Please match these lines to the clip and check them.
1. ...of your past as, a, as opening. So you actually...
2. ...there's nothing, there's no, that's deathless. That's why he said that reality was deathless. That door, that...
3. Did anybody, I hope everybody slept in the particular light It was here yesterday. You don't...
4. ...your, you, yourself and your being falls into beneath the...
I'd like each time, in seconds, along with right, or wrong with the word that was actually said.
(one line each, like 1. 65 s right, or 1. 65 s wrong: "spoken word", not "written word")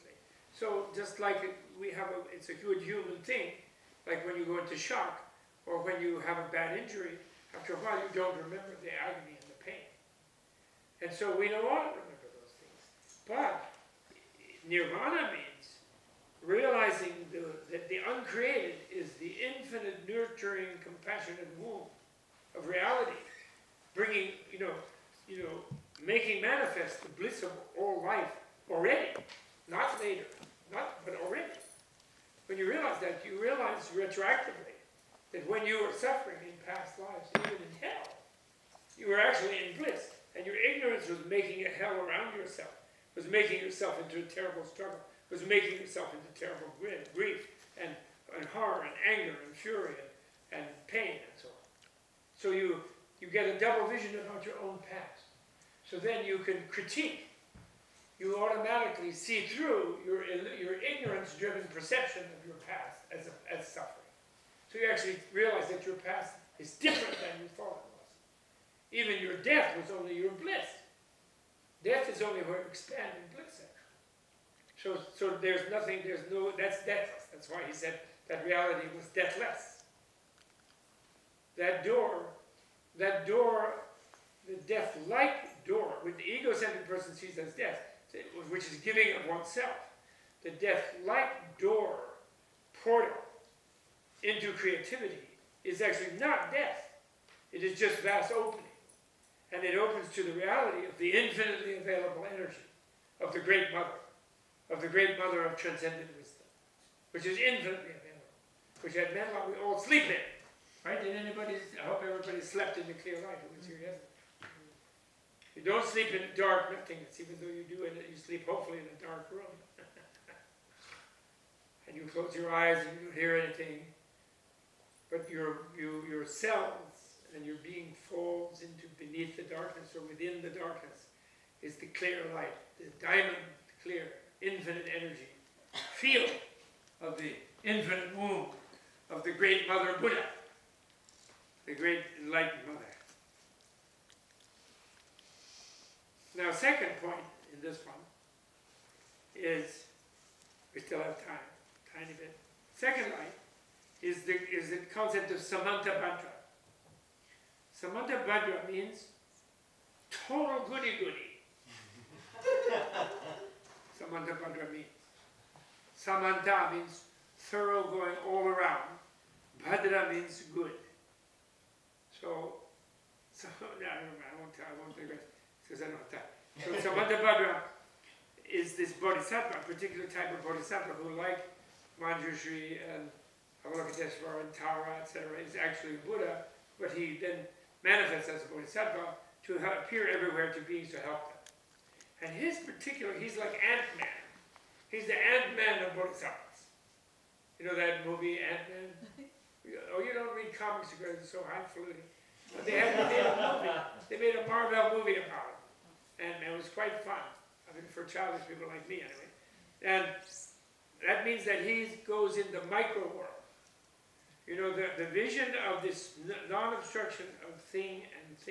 1. 62 s wrong: "suffering", not "opening"
2. 75 s right
3. 111 s wrong: "clear", not "particular"
4. 125 s right.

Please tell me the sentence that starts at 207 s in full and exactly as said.
I mean, for childish people like me, anyway.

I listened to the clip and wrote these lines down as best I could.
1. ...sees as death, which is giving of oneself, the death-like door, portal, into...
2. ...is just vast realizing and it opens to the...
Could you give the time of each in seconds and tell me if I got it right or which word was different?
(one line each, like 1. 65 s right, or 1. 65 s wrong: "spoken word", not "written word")
1. 87 s right
2. 97 s wrong: "opening", not "realizing".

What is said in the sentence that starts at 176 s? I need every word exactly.
So Samantabhadra is this bodhisattva, a particular type of bodhisattva who like Manjushri and Avalokiteshvara and Tara, etc.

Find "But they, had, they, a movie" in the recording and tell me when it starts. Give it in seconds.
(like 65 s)
202 s.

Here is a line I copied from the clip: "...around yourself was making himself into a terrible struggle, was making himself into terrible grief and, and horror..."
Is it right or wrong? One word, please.
right.